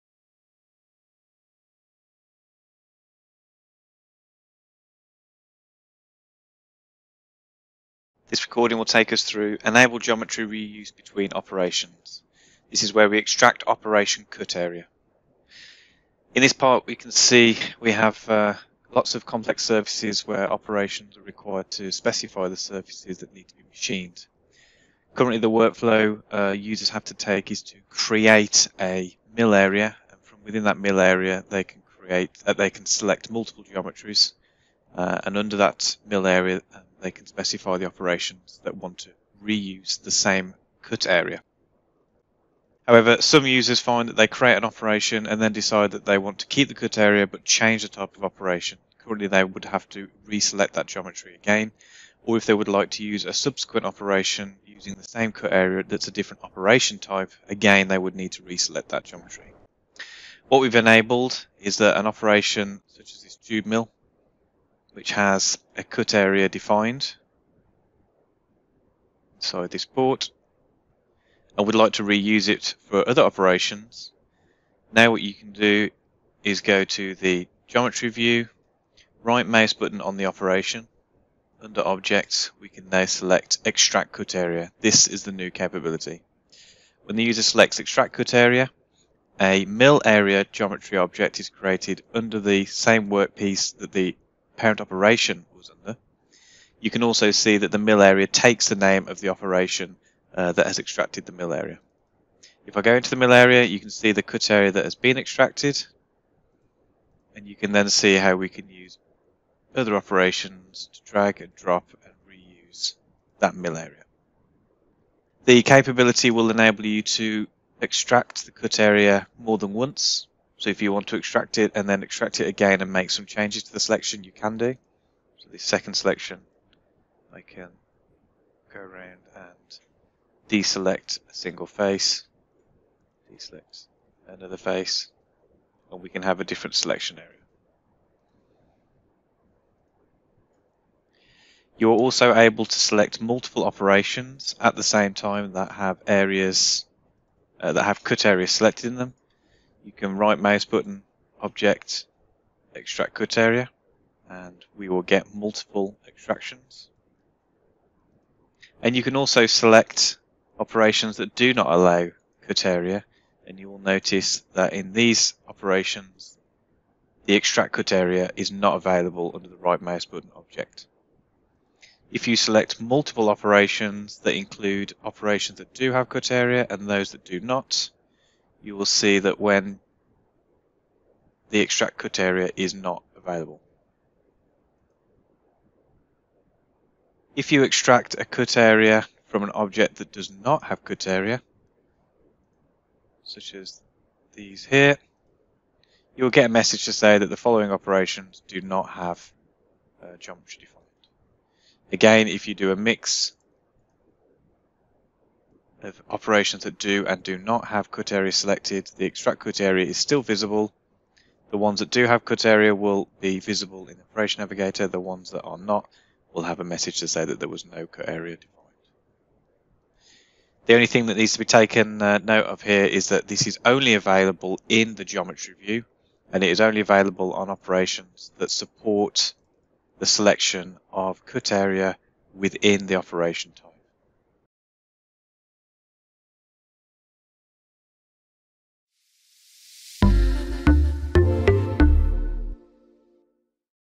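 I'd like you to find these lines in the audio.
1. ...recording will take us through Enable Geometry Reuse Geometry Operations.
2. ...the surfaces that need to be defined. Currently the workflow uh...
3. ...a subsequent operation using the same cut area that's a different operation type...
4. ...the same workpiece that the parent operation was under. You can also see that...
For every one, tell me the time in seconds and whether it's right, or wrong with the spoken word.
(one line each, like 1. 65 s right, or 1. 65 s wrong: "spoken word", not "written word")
1. 8 s wrong: "Between", not "Geometry"
2. 22 s wrong: "machined", not "defined"
3. 53 s right
4. 92 s right.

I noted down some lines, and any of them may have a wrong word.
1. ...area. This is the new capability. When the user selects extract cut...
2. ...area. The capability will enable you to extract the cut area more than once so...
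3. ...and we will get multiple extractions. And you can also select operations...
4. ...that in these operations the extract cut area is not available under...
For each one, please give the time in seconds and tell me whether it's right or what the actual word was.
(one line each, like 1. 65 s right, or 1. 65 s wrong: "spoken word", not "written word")
1. 84 s right
2. 113 s right
3. 154 s right
4. 164 s right.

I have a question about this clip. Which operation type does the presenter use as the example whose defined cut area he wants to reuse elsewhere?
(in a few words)
tube mill.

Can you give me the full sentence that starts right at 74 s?
Now what you can do is go to the geometry view, right mouse button on the operation.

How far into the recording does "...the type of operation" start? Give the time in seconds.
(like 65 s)
47 s.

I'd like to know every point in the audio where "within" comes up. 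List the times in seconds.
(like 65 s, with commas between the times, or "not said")
30 s, 232 s.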